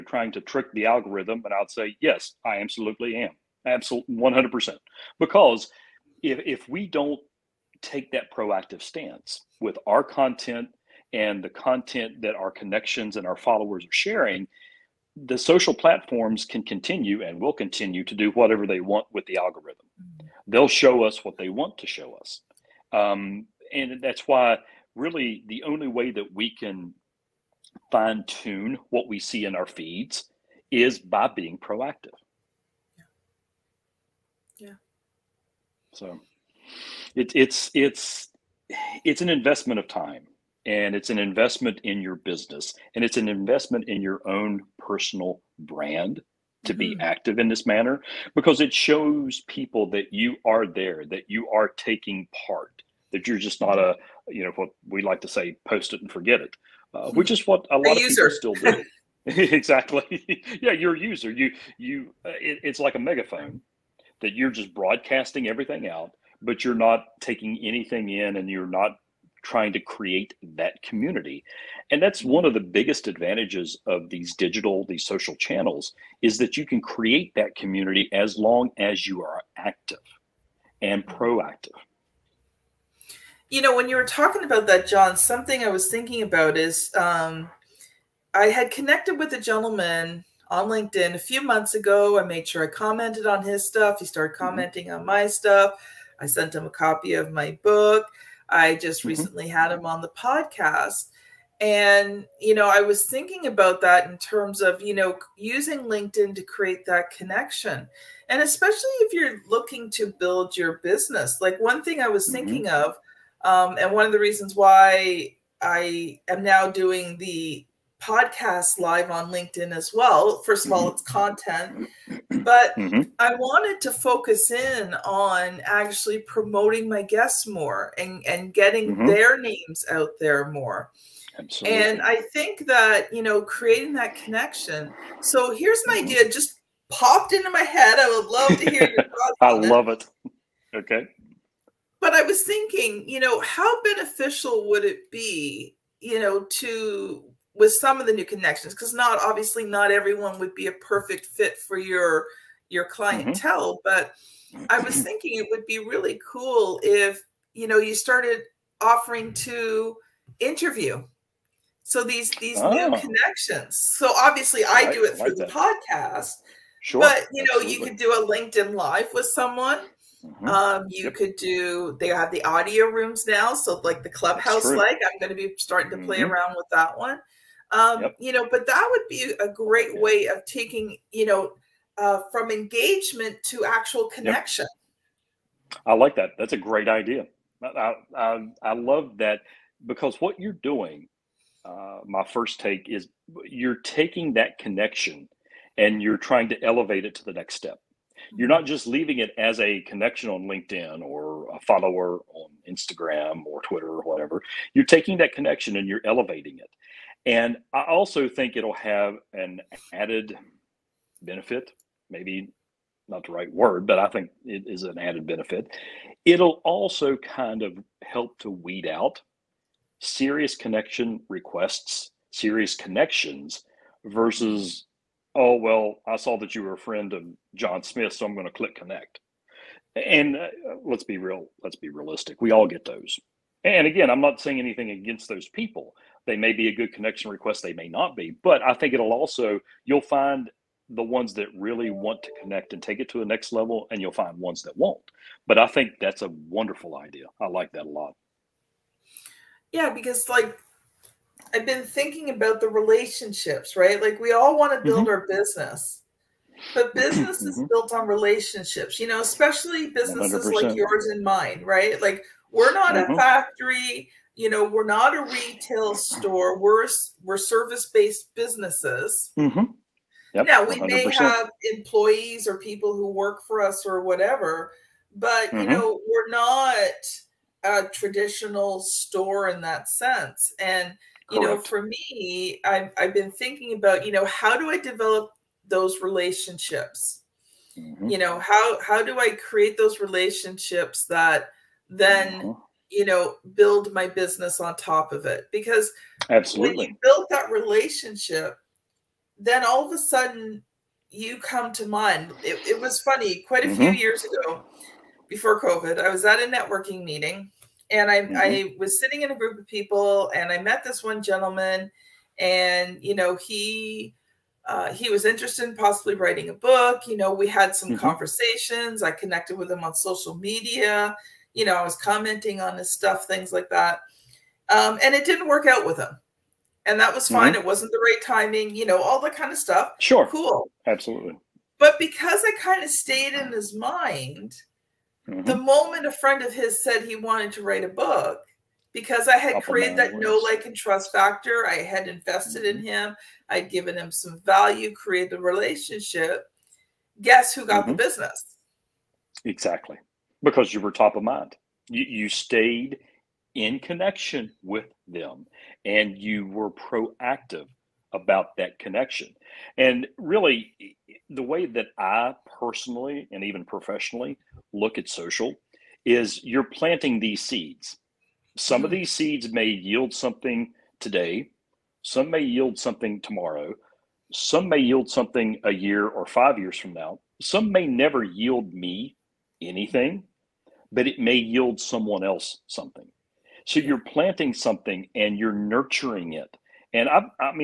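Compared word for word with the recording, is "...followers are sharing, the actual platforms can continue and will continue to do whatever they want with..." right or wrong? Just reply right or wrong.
wrong.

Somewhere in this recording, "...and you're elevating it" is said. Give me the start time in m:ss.
3:25.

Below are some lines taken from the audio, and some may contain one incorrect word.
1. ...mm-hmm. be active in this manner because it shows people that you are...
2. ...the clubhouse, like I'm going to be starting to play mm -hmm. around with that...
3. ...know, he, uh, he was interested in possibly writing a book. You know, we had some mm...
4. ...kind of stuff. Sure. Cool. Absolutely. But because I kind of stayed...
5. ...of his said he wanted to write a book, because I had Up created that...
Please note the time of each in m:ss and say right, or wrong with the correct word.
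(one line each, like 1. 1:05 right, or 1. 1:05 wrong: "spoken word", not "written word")
1. 0:46 right
2. 2:54 right
3. 5:13 right
4. 5:29 right
5. 5:36 right.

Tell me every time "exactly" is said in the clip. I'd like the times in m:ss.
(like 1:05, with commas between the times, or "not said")
0:59, 5:49.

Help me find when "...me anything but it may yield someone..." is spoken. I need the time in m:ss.
6:18.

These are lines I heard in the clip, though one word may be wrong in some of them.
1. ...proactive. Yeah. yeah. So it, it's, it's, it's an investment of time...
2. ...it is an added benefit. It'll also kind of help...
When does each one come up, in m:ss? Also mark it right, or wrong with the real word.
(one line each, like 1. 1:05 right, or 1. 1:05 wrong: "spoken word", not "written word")
1. 0:31 right
2. 3:34 right.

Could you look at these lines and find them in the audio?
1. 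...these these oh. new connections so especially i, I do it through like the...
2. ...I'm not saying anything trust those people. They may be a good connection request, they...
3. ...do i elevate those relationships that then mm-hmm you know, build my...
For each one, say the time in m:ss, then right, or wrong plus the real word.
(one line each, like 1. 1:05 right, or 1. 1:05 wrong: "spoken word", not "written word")
1. 2:42 wrong: "obviously", not "especially"
2. 3:54 wrong: "against", not "trust"
3. 4:49 wrong: "create", not "elevate".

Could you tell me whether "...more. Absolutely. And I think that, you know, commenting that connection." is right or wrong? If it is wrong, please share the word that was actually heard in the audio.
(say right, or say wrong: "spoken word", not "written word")
wrong: "creating", not "commenting".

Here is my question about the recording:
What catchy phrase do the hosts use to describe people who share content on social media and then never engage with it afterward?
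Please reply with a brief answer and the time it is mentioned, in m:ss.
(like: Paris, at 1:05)
post it and forget it, at 0:55.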